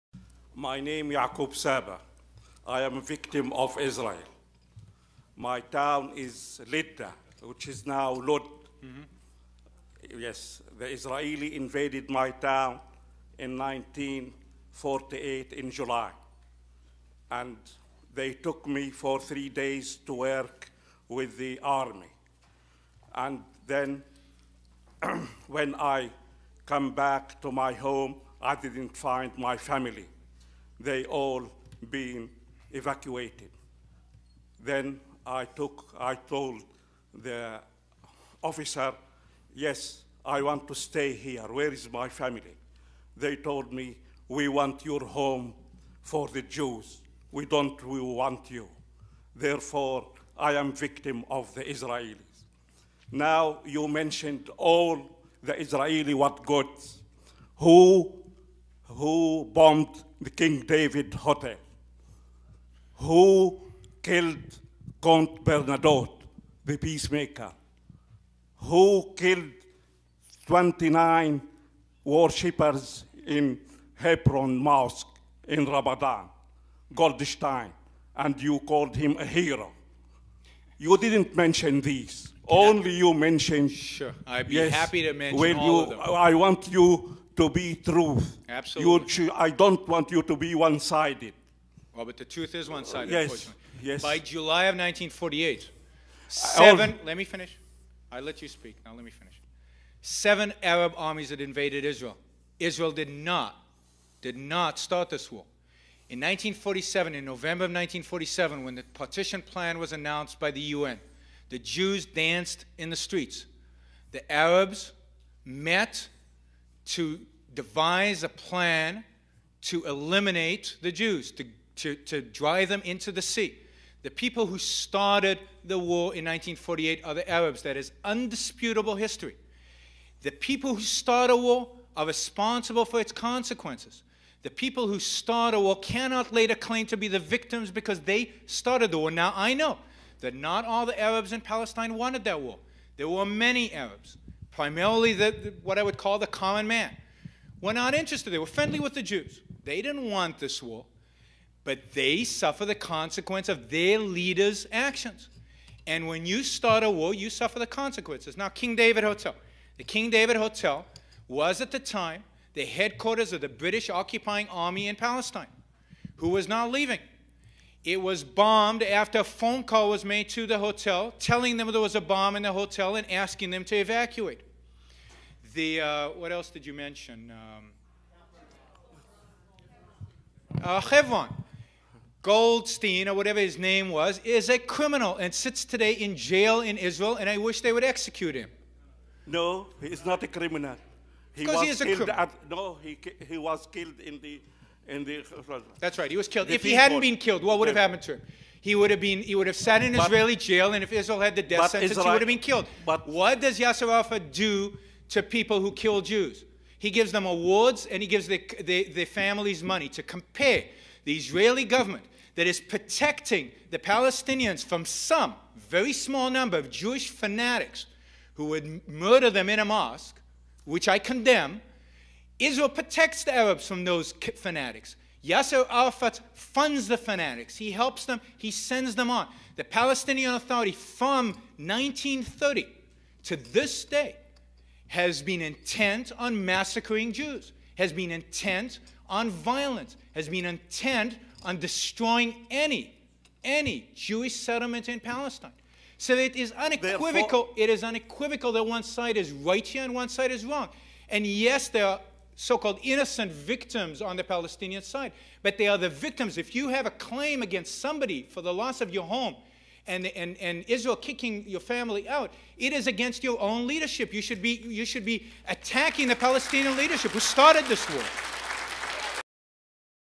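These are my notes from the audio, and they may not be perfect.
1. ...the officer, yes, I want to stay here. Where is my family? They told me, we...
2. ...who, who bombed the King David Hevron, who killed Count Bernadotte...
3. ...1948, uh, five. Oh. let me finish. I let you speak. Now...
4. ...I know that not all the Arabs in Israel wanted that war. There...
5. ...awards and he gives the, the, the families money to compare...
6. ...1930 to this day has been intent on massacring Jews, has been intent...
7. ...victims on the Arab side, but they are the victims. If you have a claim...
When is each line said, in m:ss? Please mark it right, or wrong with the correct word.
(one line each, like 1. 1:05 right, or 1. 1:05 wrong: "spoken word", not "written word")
1. 0:37 right
2. 0:57 wrong: "Hotel", not "Hevron"
3. 1:34 wrong: "seven", not "five"
4. 2:19 wrong: "Palestine", not "Israel"
5. 3:27 right
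6. 3:51 right
7. 4:13 wrong: "Palestinian", not "Arab".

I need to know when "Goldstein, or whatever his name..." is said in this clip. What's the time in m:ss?
3:02.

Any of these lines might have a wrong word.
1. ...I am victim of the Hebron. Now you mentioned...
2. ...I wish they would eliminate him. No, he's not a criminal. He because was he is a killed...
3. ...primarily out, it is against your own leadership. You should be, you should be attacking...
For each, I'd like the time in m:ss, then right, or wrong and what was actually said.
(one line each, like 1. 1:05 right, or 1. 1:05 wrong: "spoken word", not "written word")
1. 0:50 wrong: "Israelis", not "Hebron"
2. 3:07 wrong: "execute", not "eliminate"
3. 4:21 wrong: "family", not "primarily".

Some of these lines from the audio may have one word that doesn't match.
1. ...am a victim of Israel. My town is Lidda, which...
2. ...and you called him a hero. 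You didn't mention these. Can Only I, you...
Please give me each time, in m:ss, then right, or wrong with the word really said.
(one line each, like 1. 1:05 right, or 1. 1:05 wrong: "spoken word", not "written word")
1. 0:02 right
2. 1:18 right.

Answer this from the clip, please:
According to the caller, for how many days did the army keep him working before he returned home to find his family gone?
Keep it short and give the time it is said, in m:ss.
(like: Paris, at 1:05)
3, at 0:19.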